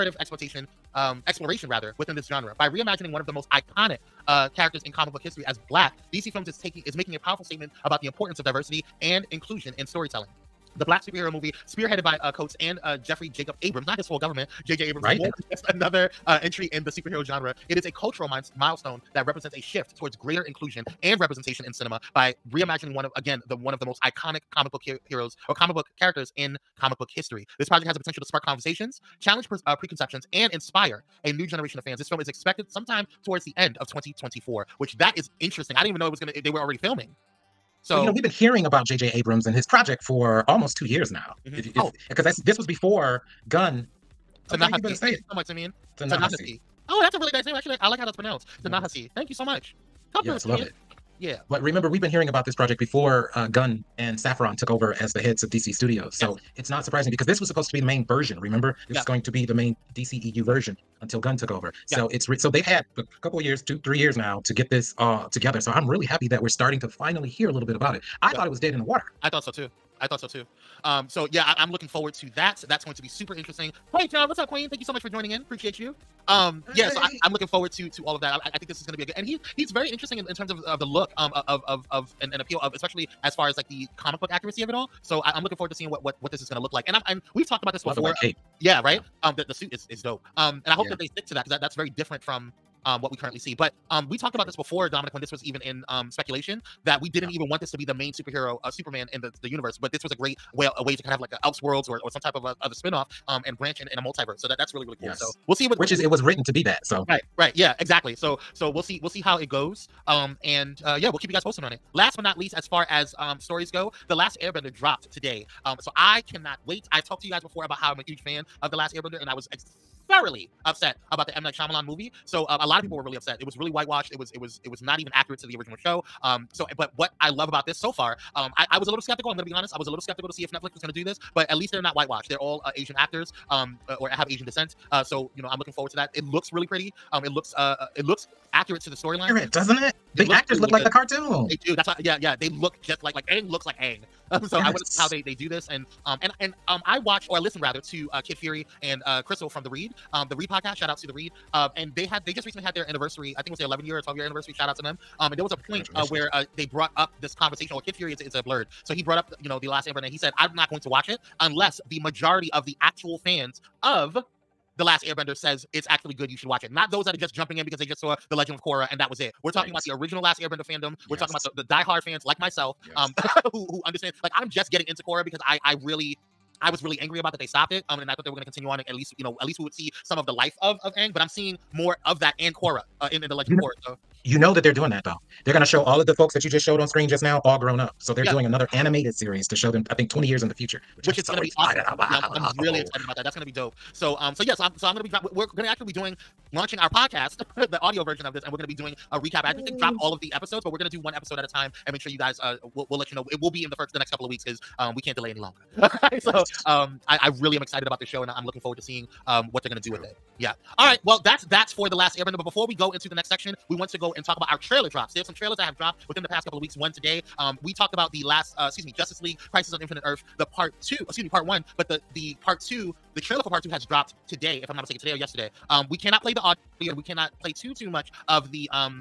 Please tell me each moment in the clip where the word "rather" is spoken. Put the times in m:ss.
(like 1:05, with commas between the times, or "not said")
0:01, 2:27.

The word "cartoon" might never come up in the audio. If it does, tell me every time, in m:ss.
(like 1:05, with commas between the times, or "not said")
2:20.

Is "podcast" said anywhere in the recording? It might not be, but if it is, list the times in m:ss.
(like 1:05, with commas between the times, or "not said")
2:30, 3:16.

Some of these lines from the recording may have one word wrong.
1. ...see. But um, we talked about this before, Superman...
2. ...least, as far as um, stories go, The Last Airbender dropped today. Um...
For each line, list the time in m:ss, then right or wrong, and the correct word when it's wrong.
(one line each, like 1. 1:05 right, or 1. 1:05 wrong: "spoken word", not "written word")
1. 1:33 wrong: "Dominic", not "Superman"
2. 1:52 right.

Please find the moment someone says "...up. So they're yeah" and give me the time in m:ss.
3:07.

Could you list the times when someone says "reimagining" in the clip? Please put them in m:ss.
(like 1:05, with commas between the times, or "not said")
0:02, 0:22.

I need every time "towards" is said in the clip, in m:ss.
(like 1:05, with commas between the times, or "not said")
0:19, 0:33.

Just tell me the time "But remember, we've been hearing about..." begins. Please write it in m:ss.
0:51.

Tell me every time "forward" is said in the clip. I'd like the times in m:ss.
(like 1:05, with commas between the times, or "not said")
1:11, 1:17, 1:25, 2:15, 3:28.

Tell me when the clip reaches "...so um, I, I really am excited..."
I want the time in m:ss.
3:26.